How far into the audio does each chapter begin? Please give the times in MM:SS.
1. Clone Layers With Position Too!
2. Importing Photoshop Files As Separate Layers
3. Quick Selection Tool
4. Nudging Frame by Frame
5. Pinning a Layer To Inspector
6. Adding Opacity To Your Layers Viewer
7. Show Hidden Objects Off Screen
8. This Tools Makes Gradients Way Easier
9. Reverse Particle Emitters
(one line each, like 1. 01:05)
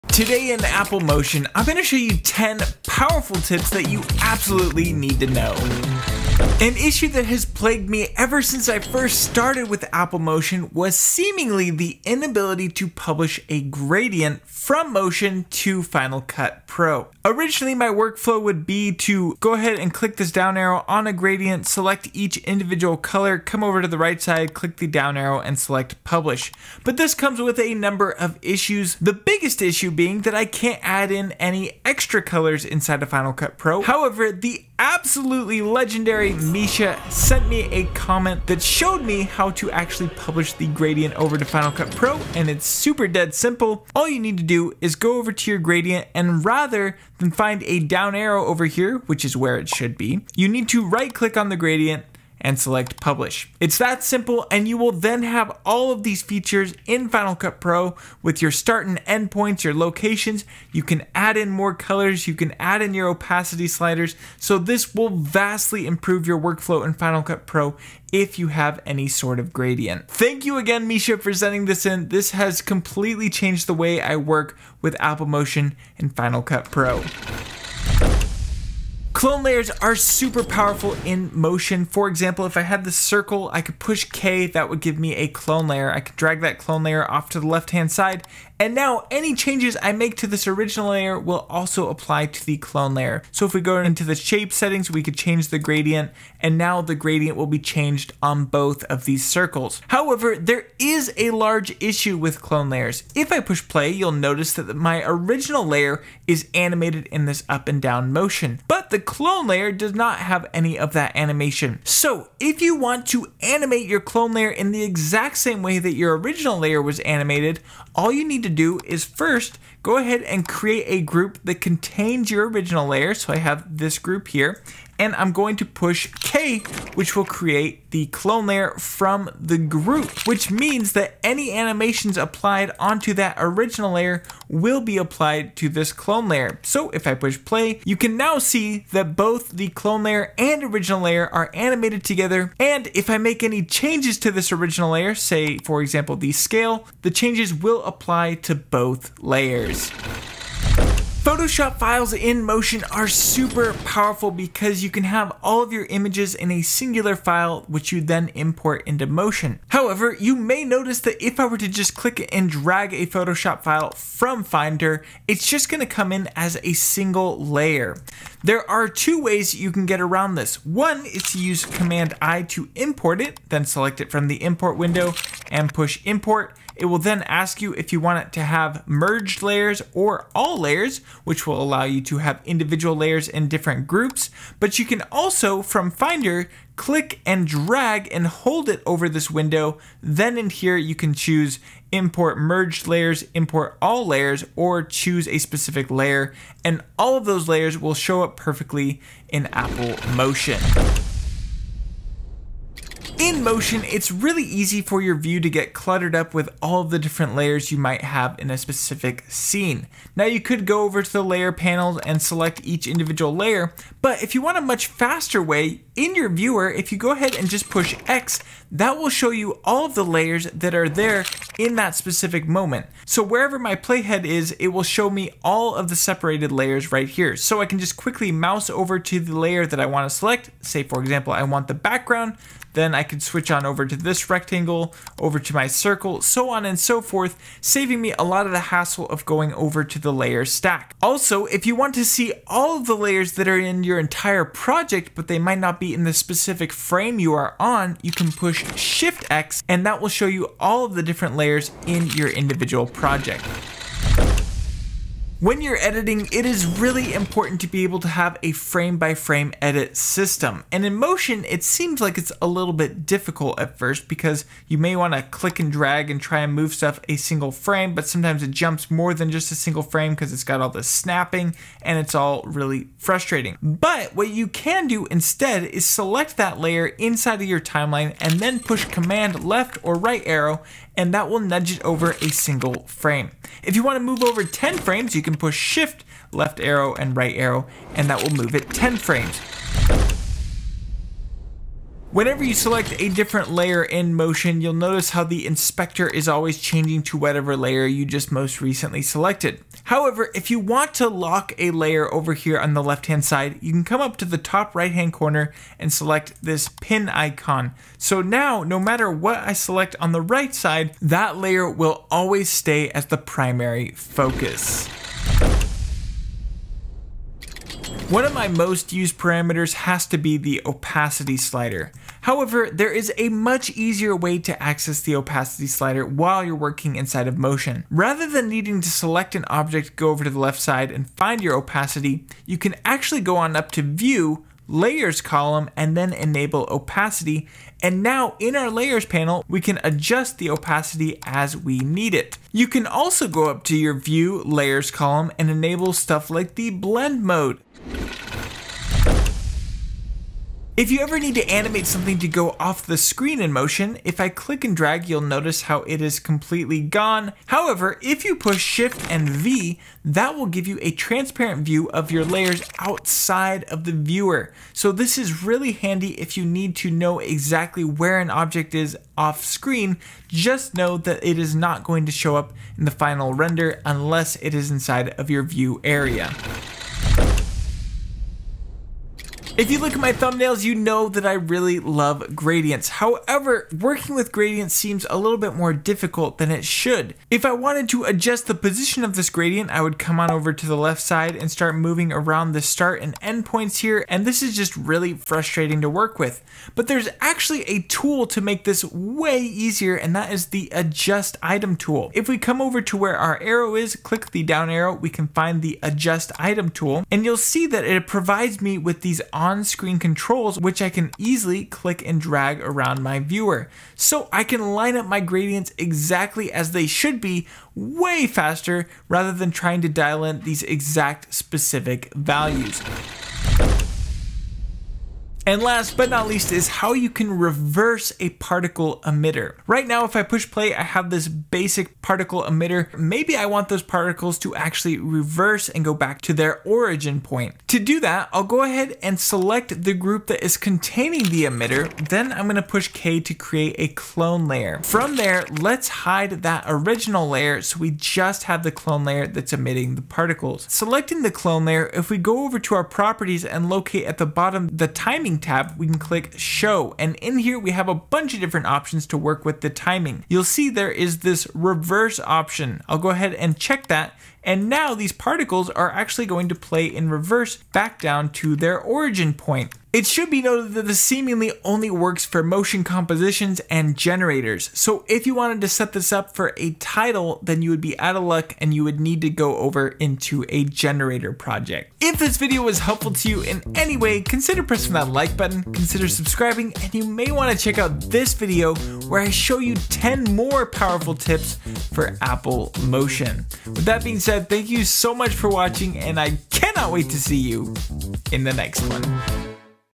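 1. 01:19
2. 02:31
3. 03:23
4. 04:15
5. 04:52
6. 05:17
7. 05:50
8. 06:19
9. 07:05.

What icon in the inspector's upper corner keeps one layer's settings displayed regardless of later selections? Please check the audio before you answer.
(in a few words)
pin icon.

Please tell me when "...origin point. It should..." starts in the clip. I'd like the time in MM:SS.
07:48.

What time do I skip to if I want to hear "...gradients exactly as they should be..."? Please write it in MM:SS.
06:55.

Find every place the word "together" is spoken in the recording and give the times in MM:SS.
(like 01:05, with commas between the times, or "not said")
02:22.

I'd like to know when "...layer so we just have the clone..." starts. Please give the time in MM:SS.
07:27.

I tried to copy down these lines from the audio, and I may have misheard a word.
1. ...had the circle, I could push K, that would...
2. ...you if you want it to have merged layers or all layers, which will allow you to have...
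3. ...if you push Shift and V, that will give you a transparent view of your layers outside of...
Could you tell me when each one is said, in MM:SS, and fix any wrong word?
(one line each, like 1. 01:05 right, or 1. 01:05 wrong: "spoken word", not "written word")
1. 01:22 right
2. 02:57 right
3. 05:58 right.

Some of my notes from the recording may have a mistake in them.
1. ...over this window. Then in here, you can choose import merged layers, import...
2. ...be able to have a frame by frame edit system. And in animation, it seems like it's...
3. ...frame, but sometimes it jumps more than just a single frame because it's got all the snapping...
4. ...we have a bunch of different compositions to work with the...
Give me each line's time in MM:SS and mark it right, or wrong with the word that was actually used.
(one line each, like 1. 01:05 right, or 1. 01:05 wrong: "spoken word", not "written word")
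1. 03:08 right
2. 04:17 wrong: "motion", not "animation"
3. 04:27 right
4. 07:37 wrong: "options", not "compositions".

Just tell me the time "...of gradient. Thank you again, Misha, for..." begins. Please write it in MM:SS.
01:09.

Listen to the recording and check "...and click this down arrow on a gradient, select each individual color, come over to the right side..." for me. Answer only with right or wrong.
right.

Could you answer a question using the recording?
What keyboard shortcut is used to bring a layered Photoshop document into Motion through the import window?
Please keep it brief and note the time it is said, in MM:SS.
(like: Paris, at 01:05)
Command I, at 02:51.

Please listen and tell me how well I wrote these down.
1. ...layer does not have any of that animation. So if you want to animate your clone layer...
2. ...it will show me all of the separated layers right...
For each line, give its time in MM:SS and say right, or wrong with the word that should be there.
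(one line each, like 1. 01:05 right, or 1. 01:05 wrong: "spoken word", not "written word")
1. 01:49 right
2. 03:44 right.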